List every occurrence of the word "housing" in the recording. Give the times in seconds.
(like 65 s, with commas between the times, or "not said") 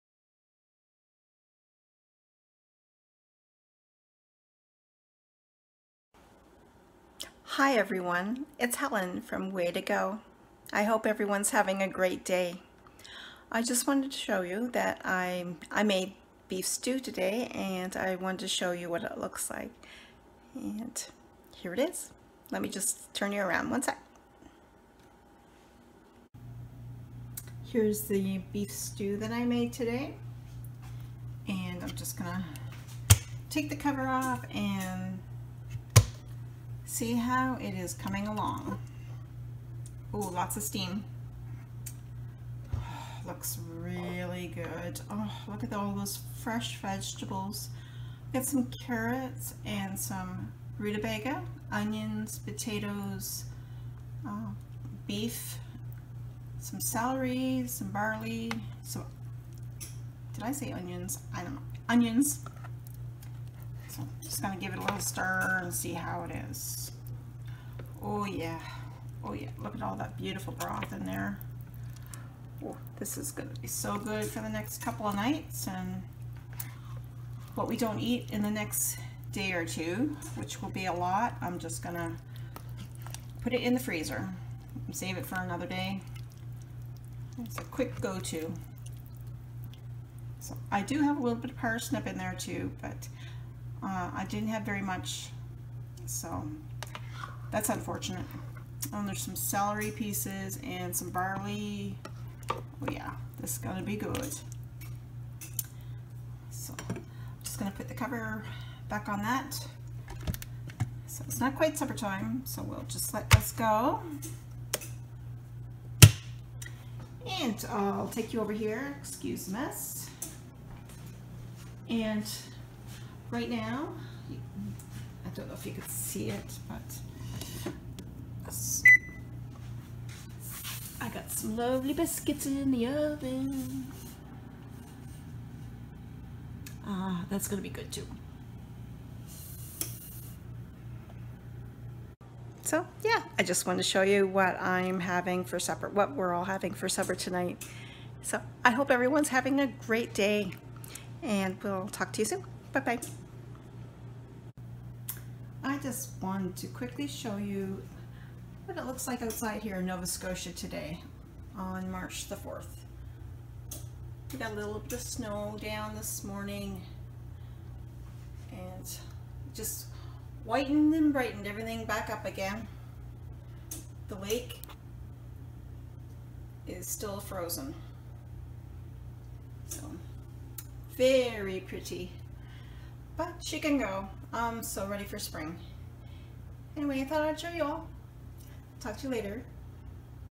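not said.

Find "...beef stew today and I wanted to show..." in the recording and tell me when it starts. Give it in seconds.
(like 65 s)
16 s.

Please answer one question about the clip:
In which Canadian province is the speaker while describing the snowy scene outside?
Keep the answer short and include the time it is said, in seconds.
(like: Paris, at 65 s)
Nova Scotia, at 159 s.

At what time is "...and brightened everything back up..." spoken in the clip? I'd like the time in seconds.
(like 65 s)
170 s.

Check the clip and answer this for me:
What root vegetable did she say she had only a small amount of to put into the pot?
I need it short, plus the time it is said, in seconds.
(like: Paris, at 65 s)
parsnip, at 91 s.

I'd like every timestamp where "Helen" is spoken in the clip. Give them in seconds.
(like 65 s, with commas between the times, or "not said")
8 s.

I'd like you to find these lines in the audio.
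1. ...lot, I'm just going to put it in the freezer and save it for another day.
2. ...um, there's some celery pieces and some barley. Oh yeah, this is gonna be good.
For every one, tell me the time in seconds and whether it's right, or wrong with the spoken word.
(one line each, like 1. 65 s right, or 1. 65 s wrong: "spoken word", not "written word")
1. 80 s right
2. 98 s right.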